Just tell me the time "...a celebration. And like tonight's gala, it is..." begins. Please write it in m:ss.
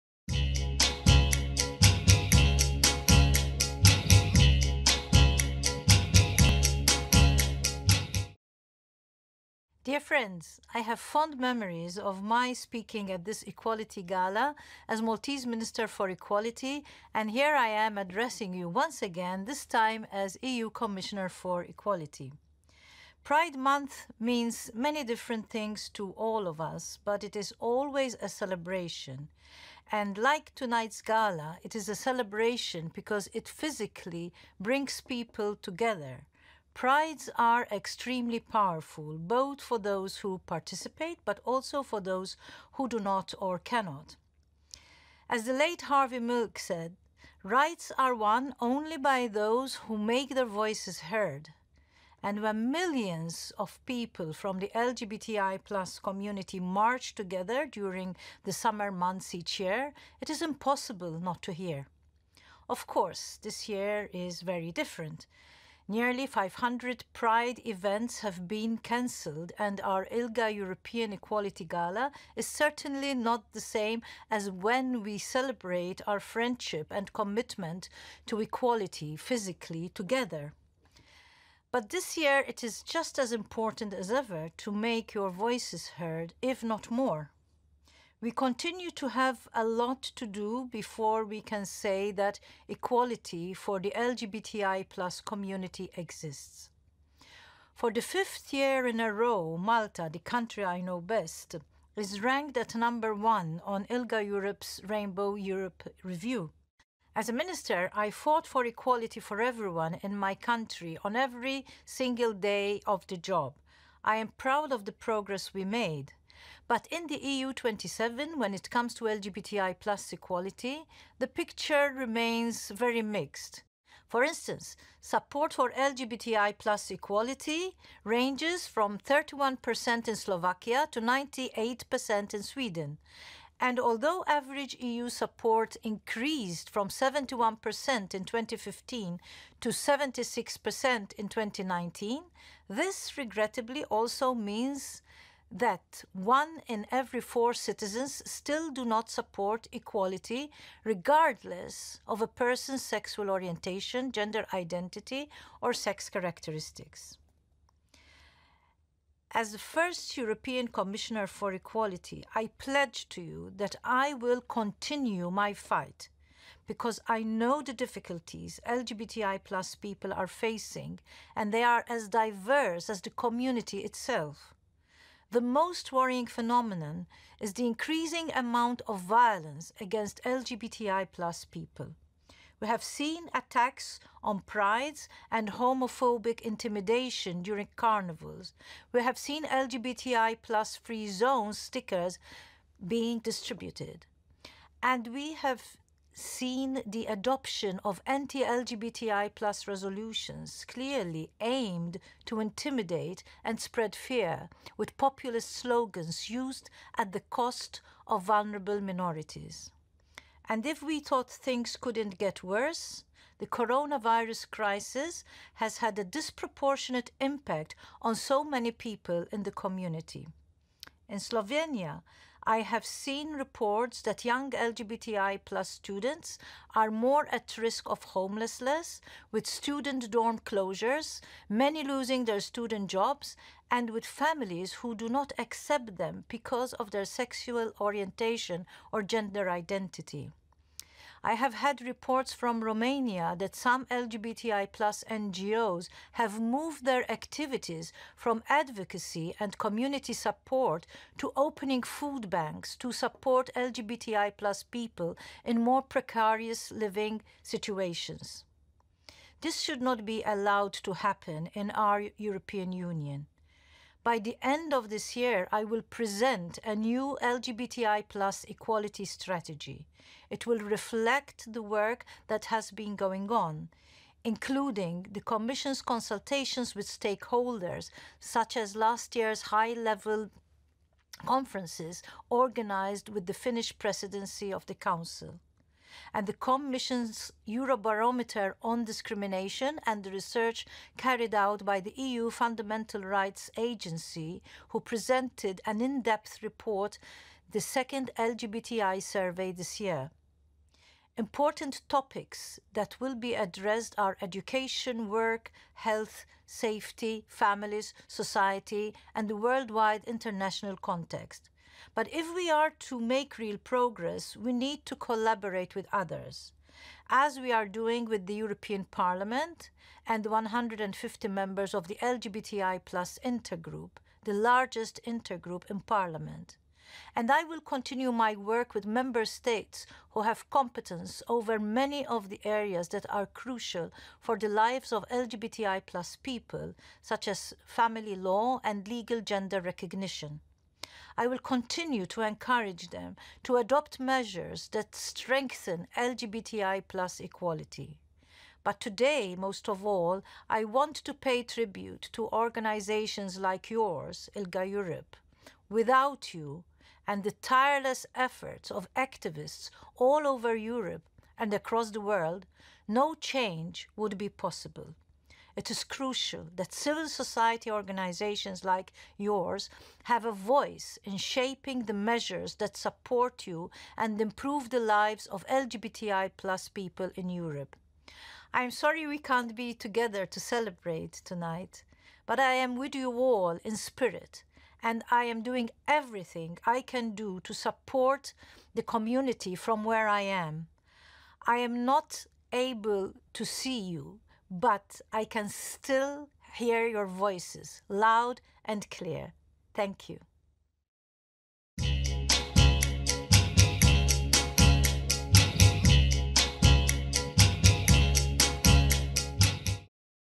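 0:28.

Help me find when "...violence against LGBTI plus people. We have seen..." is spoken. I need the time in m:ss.
2:58.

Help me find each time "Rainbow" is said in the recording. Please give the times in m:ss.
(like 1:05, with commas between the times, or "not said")
1:44.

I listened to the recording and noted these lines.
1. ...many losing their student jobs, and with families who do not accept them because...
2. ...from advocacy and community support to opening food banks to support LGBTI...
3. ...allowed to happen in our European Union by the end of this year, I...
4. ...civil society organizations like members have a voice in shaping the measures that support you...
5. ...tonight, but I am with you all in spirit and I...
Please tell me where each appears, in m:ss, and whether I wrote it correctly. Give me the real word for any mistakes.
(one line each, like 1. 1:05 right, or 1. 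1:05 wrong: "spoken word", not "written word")
1. 3:51 right
2. 4:08 right
3. 4:20 right
4. 6:06 wrong: "yours", not "members"
5. 6:21 right.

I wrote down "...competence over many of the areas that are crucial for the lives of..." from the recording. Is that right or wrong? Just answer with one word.
right.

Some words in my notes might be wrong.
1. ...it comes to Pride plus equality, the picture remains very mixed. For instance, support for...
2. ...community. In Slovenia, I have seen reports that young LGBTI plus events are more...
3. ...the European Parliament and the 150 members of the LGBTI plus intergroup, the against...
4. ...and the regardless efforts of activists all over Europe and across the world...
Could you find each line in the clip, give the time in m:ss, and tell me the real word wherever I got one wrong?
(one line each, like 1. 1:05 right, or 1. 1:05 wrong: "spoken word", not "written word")
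1. 1:58 wrong: "LGBTI", not "Pride"
2. 3:39 wrong: "students", not "events"
3. 5:18 wrong: "largest", not "against"
4. 5:57 wrong: "tireless", not "regardless".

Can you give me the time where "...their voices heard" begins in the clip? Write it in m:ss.
0:50.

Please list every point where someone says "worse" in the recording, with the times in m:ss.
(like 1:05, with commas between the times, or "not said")
3:32.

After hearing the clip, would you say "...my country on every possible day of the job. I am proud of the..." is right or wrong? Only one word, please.
wrong.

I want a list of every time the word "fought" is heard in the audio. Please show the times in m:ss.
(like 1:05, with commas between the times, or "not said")
1:48.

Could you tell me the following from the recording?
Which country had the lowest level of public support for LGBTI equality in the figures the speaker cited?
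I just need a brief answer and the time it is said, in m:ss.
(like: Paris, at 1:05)
Slovakia, at 2:08.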